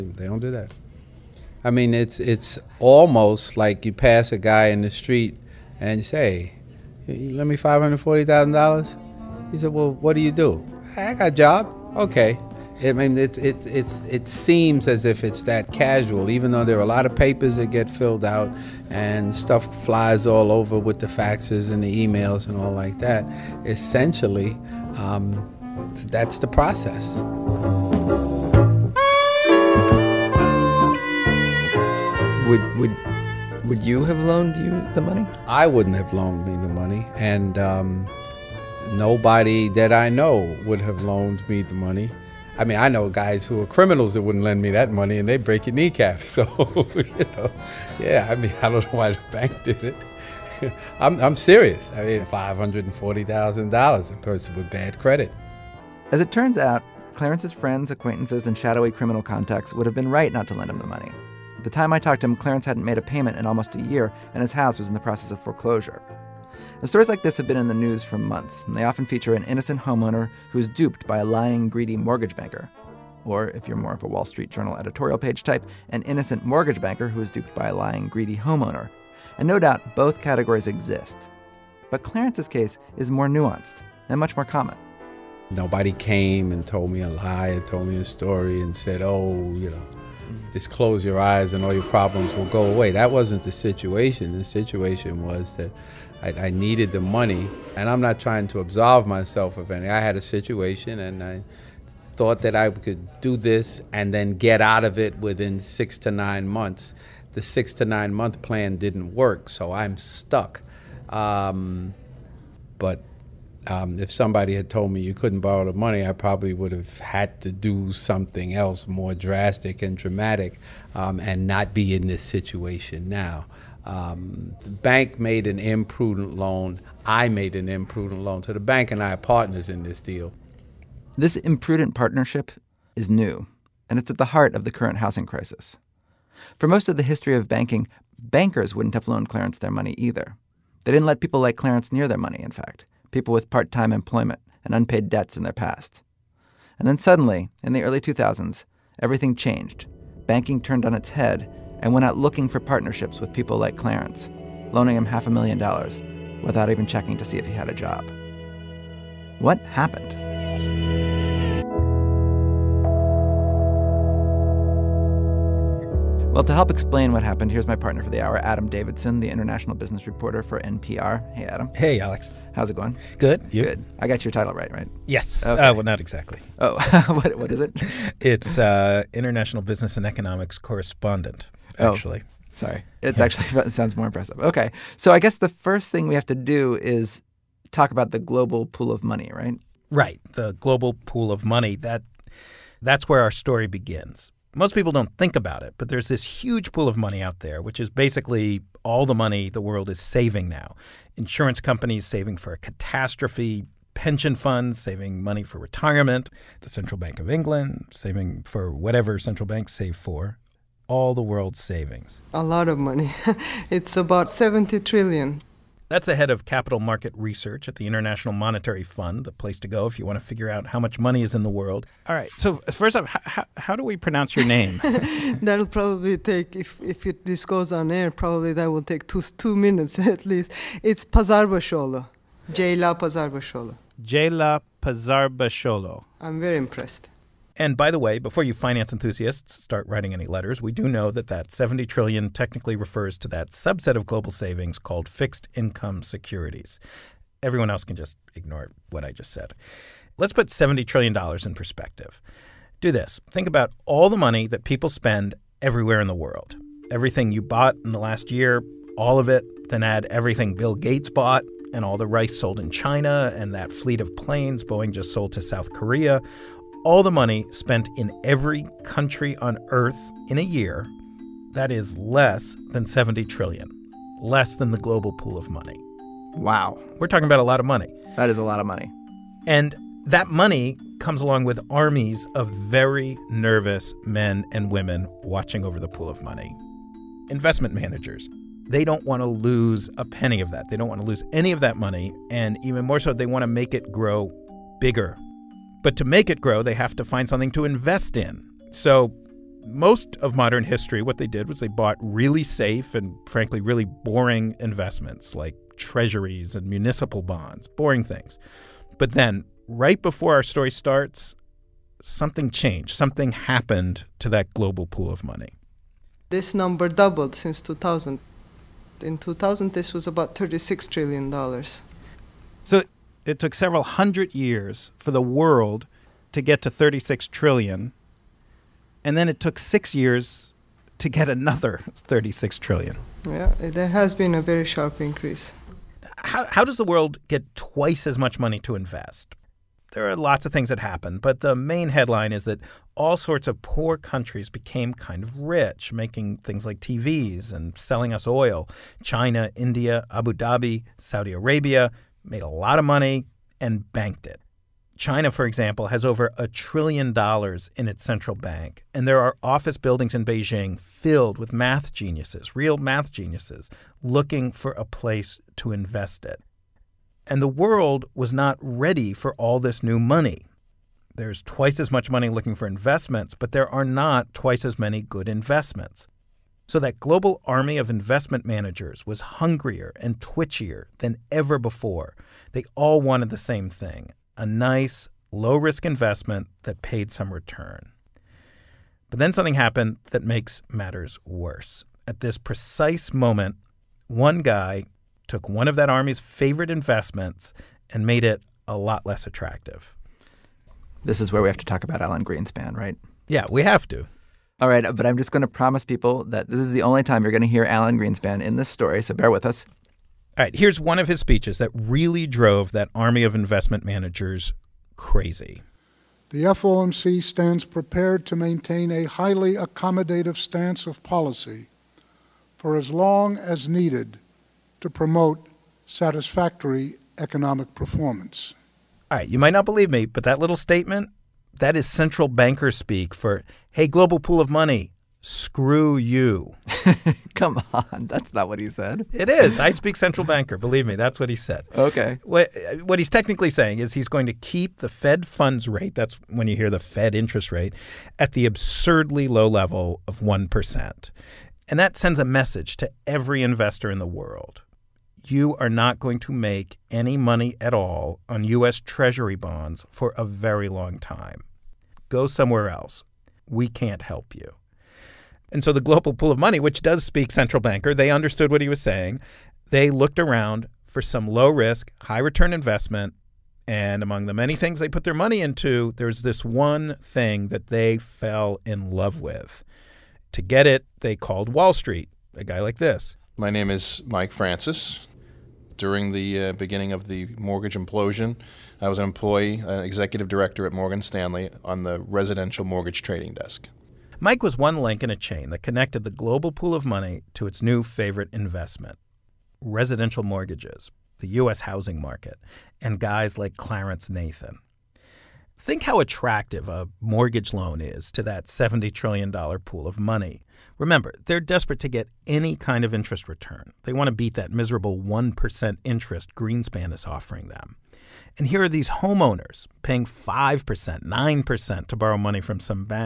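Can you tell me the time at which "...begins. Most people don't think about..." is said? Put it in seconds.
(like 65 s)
193 s.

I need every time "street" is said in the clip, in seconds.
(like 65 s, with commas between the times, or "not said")
4 s, 74 s, 481 s.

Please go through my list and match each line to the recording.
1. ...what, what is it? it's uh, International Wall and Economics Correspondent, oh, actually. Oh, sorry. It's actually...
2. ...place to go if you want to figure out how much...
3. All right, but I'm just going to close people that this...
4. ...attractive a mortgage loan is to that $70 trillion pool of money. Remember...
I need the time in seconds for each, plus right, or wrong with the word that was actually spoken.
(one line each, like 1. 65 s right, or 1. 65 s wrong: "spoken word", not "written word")
1. 177 s wrong: "Business", not "Wall"
2. 219 s right
3. 404 s wrong: "promise", not "close"
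4. 505 s right.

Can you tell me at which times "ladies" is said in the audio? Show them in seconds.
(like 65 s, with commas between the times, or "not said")
not said.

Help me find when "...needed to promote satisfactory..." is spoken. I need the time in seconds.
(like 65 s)
423 s.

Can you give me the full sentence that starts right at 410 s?
All right, here's one of his speeches that really drove that army of investment managers crazy.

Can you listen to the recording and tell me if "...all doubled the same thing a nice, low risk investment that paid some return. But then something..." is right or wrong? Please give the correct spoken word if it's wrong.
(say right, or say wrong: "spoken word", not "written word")
wrong: "wanted", not "doubled".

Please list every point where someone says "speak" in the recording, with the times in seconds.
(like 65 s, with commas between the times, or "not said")
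432 s, 439 s, 467 s.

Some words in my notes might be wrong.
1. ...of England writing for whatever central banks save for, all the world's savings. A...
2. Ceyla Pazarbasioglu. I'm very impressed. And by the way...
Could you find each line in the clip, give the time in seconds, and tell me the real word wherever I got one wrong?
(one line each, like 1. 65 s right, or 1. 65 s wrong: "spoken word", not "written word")
1. 207 s wrong: "saving", not "writing"
2. 234 s right.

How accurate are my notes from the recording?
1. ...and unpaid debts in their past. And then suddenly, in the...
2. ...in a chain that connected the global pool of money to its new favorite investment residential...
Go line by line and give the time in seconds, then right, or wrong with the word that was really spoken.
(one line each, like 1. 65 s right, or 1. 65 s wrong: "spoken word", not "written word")
1. 144 s right
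2. 495 s right.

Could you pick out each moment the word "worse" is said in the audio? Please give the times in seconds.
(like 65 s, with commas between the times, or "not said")
391 s.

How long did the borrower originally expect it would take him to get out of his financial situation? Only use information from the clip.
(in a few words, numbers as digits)
six to nine months.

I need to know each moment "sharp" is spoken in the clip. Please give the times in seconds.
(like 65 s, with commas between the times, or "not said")
334 s.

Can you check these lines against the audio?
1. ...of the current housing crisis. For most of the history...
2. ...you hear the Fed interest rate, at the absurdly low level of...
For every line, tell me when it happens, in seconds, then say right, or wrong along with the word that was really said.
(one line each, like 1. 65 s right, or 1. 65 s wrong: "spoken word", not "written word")
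1. 134 s right
2. 446 s right.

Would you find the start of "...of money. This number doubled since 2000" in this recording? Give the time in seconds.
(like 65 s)
315 s.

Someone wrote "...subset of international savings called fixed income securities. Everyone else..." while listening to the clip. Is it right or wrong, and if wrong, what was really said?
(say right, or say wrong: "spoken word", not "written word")
wrong: "global", not "international".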